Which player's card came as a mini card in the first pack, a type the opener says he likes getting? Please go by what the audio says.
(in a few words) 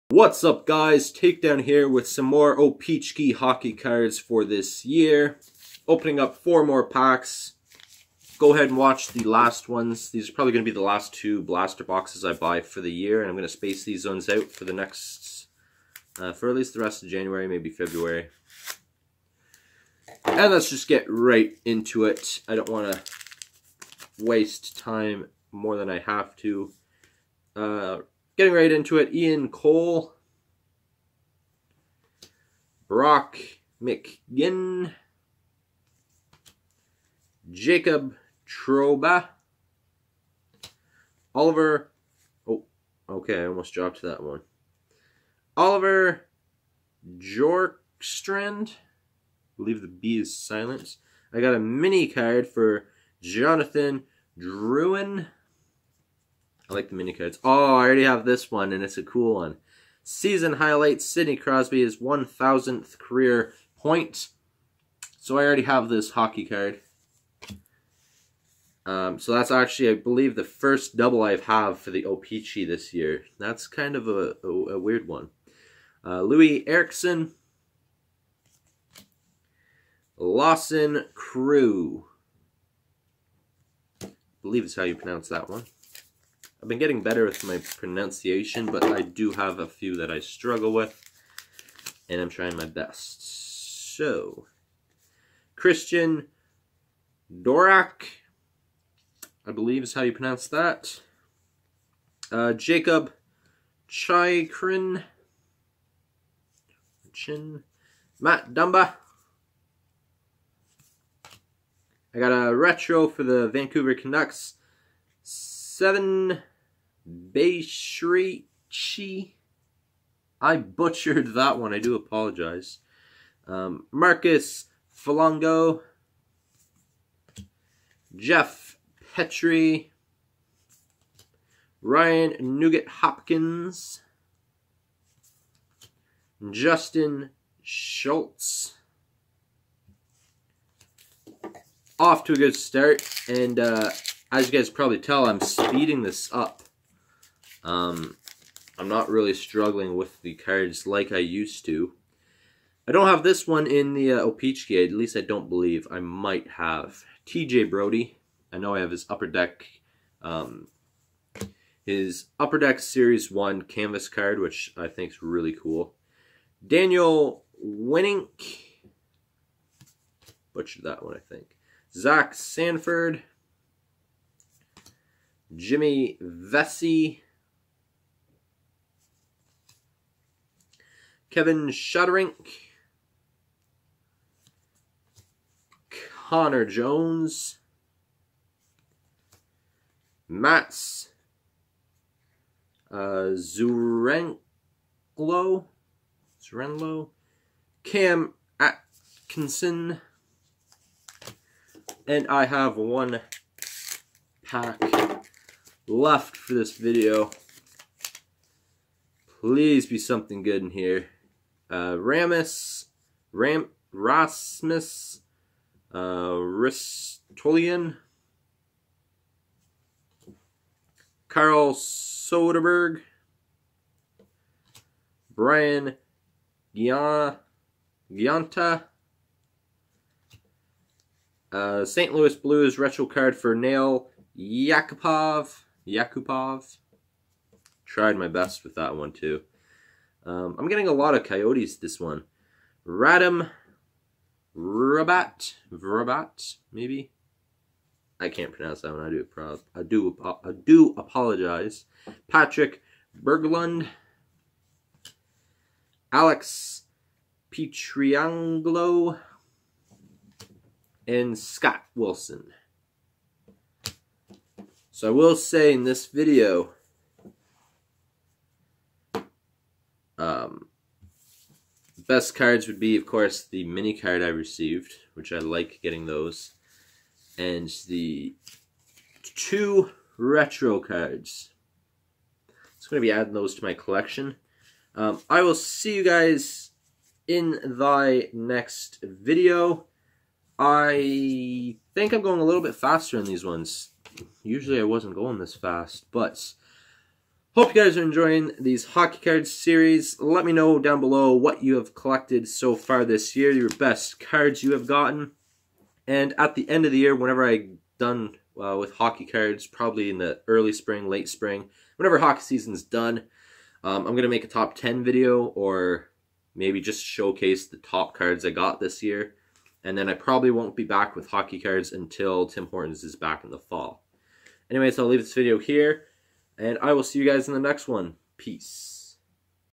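Jonathan Drouin.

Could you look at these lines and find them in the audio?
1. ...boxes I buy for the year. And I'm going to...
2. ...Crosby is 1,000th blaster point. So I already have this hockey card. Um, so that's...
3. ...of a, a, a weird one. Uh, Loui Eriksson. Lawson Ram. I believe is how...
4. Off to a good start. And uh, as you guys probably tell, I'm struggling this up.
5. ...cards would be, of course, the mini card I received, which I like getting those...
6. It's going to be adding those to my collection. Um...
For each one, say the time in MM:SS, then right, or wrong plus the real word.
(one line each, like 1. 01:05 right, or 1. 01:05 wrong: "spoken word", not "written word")
1. 00:11 right
2. 01:01 wrong: "career", not "blaster"
3. 01:13 wrong: "Crew", not "Ram"
4. 02:21 wrong: "speeding", not "struggling"
5. 04:32 right
6. 04:42 right.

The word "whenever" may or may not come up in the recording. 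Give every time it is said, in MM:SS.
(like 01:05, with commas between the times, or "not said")
05:07, 05:11.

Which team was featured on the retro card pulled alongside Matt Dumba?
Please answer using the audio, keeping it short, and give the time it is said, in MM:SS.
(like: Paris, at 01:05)
Vancouver Canucks, at 01:53.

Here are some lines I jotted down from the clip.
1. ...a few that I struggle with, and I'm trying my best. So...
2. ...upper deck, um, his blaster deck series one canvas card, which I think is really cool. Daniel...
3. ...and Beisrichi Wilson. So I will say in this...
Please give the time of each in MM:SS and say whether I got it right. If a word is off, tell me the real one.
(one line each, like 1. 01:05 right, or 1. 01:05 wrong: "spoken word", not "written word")
1. 01:29 right
2. 02:39 wrong: "upper", not "blaster"
3. 04:21 wrong: "Scott", not "Beisrichi".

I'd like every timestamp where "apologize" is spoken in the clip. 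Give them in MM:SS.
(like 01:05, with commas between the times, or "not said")
02:01, 04:10.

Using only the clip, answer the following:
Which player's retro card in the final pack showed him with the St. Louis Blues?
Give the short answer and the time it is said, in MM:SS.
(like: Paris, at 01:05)
Nail Yakupov, at 03:53.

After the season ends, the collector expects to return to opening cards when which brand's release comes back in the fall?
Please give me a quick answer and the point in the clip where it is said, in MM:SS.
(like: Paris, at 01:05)
Tim Hortons, at 05:22.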